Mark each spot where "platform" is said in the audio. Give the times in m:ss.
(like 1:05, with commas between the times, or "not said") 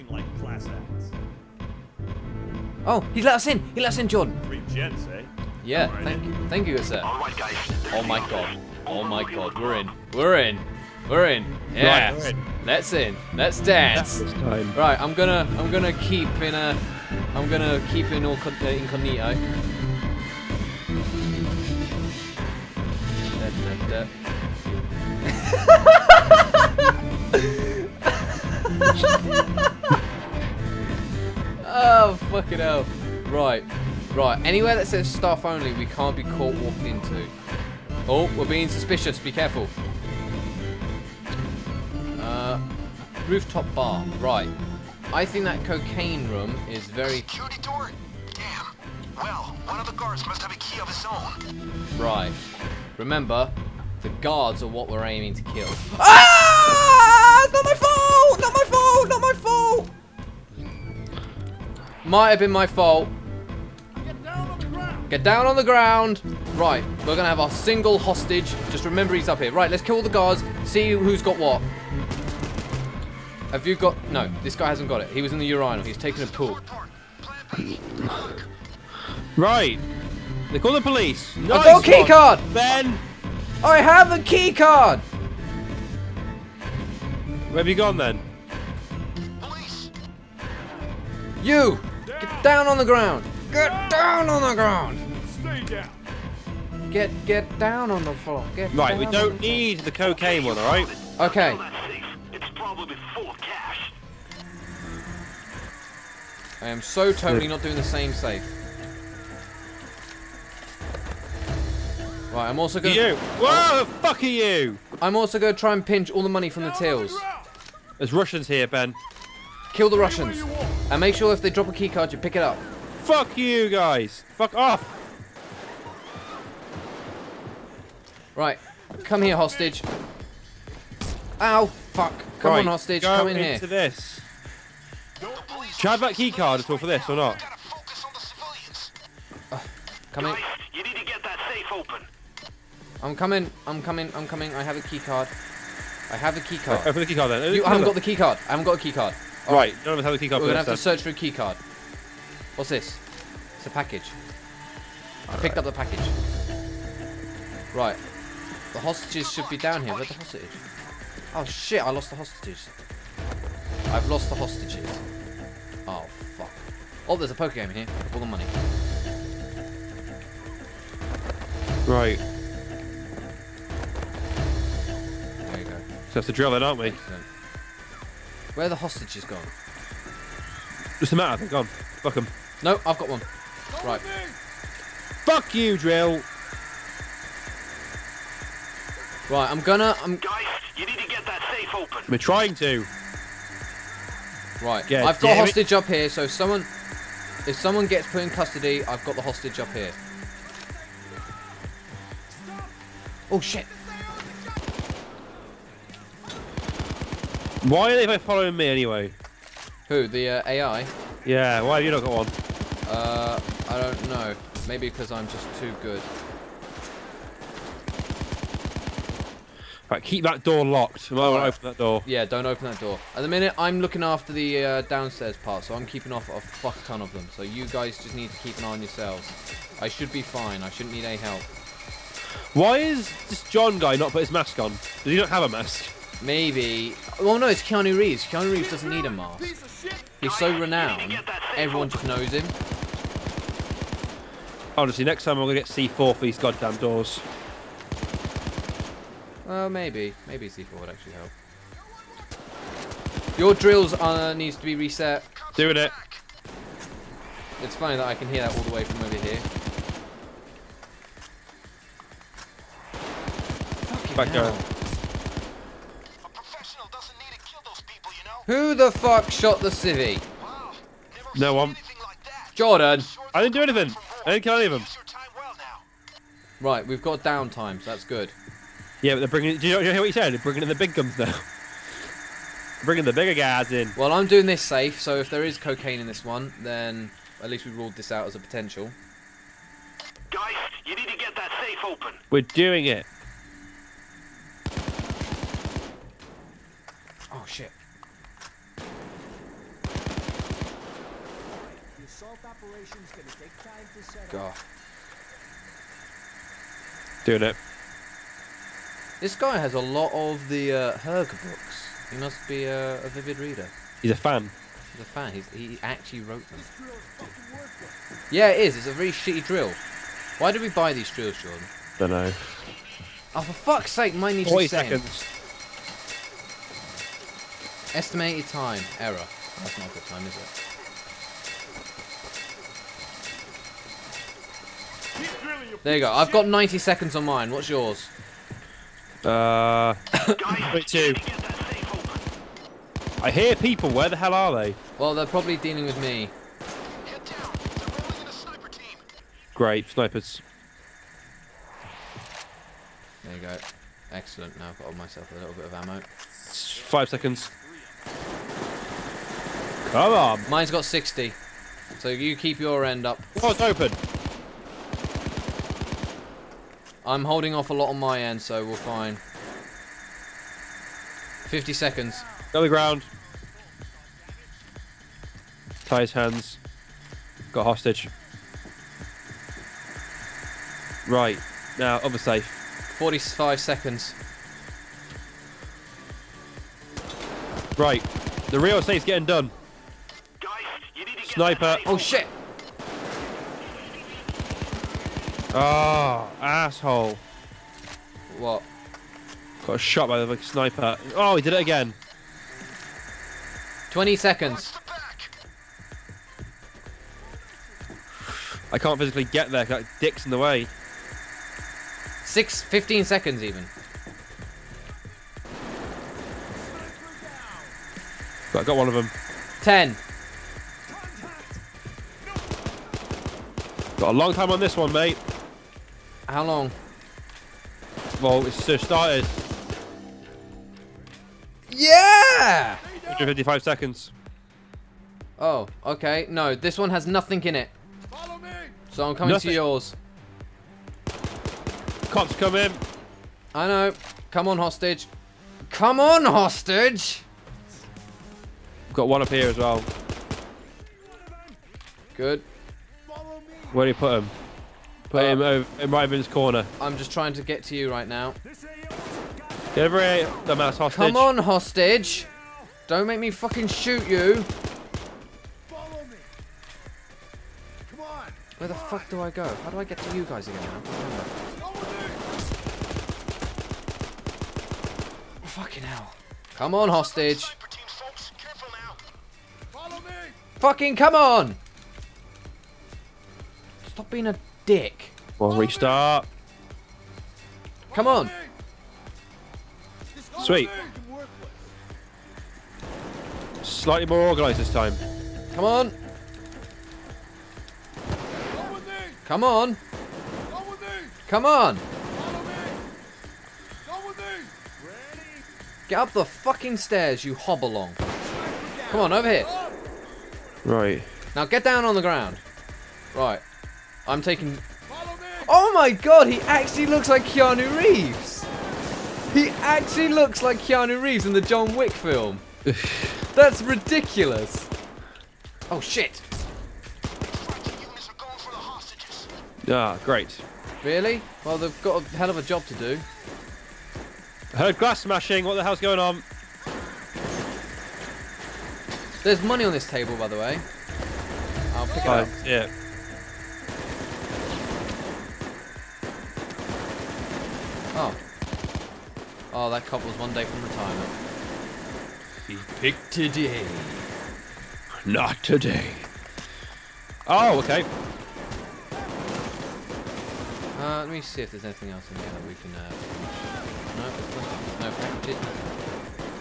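not said.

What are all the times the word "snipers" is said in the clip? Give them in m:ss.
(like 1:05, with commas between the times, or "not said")
5:49, 6:31, 6:40.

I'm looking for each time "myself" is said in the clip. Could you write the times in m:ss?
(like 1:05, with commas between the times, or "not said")
5:54.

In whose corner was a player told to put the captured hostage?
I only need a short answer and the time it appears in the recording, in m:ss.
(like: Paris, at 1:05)
Raven's corner, at 7:35.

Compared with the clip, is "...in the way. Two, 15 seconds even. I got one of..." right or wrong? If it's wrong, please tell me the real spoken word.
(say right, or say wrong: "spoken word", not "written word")
wrong: "Six", not "Two".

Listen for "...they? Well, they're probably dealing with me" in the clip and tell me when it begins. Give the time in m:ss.
5:44.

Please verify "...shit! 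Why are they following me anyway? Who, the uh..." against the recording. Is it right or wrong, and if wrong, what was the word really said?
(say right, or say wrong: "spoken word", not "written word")
right.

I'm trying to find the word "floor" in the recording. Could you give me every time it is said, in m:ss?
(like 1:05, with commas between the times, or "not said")
1:38.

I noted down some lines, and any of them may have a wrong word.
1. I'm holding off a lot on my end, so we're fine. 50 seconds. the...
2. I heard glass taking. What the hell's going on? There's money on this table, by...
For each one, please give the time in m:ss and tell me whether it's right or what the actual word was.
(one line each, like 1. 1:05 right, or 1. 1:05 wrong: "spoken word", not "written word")
1. 6:07 right
2. 8:54 wrong: "smashing", not "taking".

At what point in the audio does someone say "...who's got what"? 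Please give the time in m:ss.
1:10.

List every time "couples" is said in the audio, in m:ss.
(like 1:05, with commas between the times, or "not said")
9:09.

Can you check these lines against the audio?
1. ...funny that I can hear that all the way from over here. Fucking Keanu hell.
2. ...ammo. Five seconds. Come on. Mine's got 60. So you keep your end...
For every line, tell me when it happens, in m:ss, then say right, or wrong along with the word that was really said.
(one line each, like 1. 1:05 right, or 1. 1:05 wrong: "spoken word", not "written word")
1. 4:17 wrong: "Back", not "Keanu"
2. 5:55 right.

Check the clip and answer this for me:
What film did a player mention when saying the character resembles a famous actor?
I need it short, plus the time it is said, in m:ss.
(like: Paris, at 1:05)
John Wick, at 8:41.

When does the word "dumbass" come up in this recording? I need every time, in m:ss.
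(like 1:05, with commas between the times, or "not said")
7:40.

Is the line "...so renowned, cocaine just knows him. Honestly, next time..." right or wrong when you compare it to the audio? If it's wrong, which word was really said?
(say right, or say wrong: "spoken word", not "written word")
wrong: "everyone", not "cocaine".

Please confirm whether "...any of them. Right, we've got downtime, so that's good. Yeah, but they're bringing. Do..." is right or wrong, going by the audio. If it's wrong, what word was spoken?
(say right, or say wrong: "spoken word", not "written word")
right.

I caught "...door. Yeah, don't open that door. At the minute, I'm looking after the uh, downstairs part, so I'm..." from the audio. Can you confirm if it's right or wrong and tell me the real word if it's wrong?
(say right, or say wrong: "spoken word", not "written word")
right.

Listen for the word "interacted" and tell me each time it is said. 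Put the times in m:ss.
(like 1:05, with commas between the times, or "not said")
not said.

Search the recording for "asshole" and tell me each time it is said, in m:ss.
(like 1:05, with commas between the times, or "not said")
6:36.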